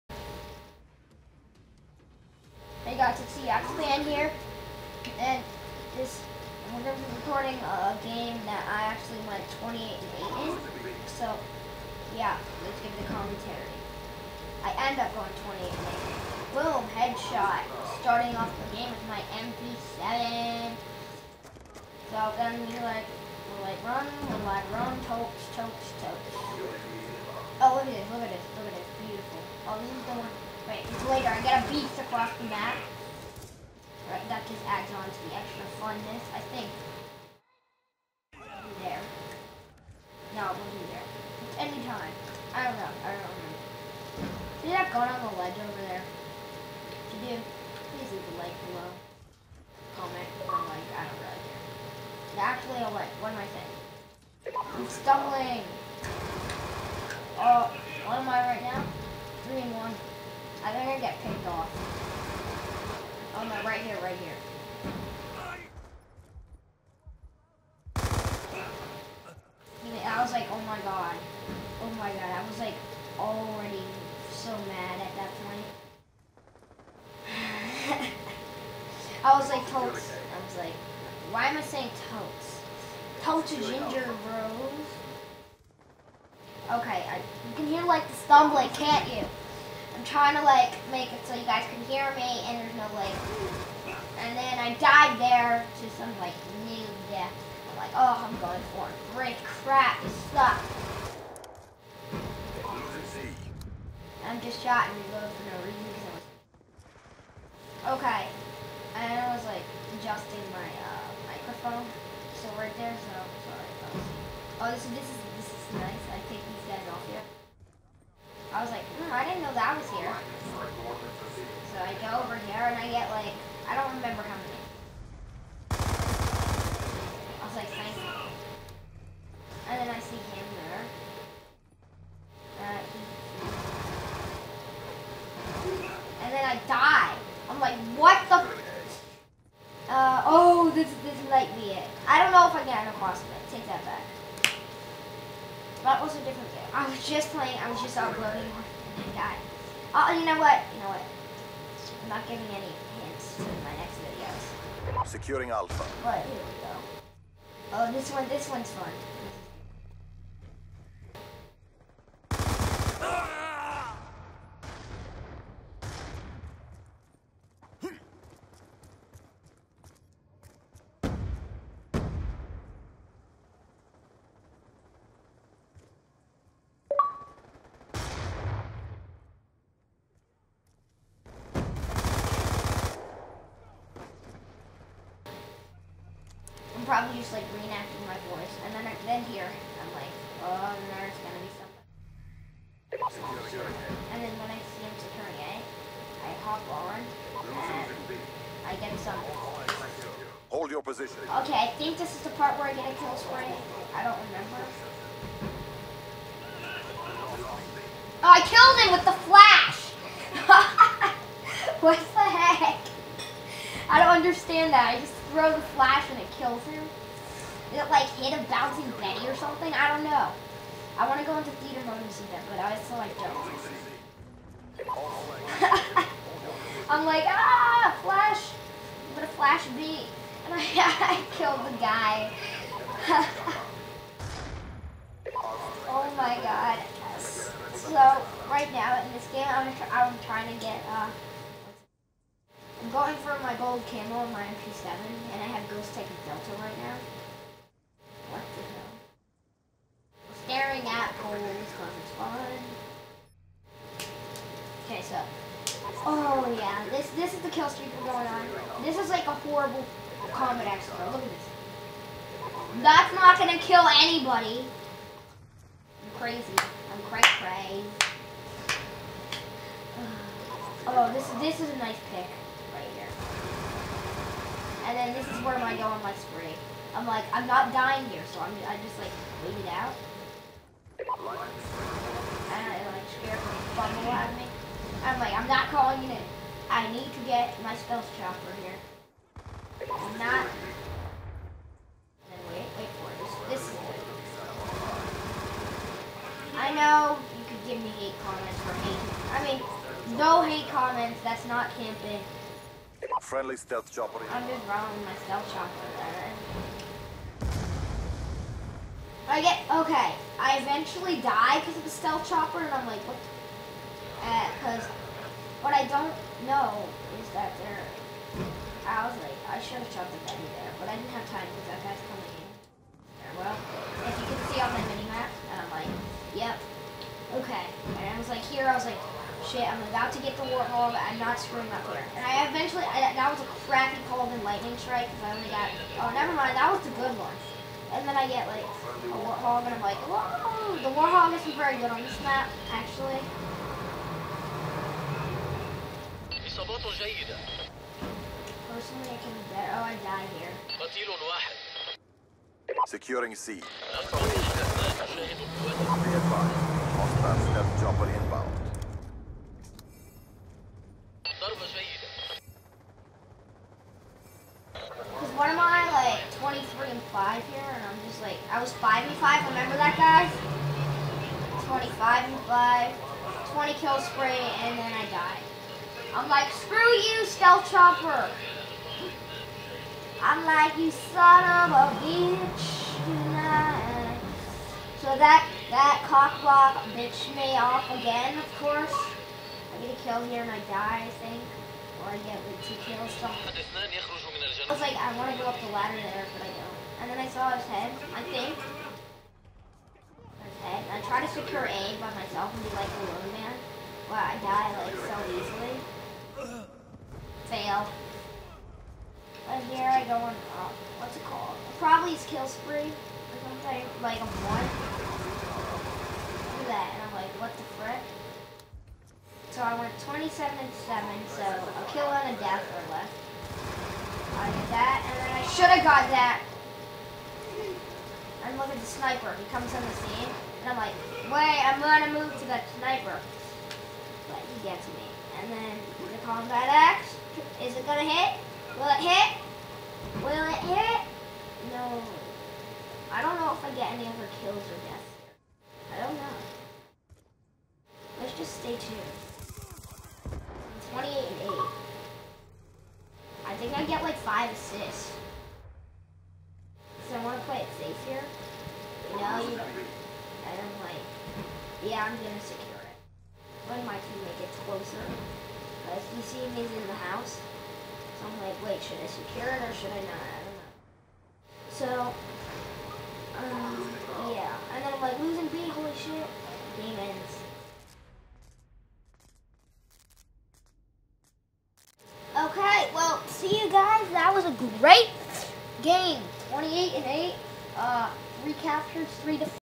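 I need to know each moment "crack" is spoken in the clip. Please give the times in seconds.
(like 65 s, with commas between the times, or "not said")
not said.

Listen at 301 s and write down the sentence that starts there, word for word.
That's not camping friendly stealth chopper.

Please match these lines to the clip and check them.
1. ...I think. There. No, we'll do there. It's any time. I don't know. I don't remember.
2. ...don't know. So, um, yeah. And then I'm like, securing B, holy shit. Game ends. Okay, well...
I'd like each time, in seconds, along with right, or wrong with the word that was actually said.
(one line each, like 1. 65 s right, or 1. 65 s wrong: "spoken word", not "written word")
1. 36 s right
2. 471 s wrong: "losing", not "securing".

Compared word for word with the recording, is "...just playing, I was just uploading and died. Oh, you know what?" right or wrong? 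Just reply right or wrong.
right.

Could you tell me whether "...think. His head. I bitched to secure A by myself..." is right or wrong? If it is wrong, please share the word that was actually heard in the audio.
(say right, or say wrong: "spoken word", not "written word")
wrong: "tried", not "bitched".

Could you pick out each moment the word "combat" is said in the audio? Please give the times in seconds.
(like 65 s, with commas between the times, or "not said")
260 s, 436 s.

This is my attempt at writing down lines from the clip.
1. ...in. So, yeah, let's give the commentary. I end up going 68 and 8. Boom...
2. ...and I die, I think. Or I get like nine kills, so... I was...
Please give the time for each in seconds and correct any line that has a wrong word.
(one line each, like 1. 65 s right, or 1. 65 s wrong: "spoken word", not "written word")
1. 10 s wrong: "28", not "68"
2. 390 s wrong: "two", not "nine".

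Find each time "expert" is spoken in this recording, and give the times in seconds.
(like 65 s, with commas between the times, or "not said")
260 s.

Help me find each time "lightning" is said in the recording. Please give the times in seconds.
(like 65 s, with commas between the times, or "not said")
334 s.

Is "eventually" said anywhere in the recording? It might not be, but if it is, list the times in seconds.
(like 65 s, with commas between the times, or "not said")
310 s, 332 s.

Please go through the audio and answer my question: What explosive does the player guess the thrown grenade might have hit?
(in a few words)
Bouncing Betty.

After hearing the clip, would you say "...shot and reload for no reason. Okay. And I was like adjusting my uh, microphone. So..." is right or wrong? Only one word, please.
right.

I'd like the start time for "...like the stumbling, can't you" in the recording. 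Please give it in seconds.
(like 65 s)
87 s.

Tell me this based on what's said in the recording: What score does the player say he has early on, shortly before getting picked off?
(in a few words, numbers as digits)
3 and 1.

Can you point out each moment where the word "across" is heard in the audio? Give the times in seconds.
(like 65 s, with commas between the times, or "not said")
31 s, 142 s.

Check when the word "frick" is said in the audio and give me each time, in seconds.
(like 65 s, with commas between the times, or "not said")
417 s.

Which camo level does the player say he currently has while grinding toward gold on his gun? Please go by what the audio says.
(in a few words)
Ghost Tech Delta.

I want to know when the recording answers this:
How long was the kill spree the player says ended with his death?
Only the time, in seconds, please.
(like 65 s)
373 s.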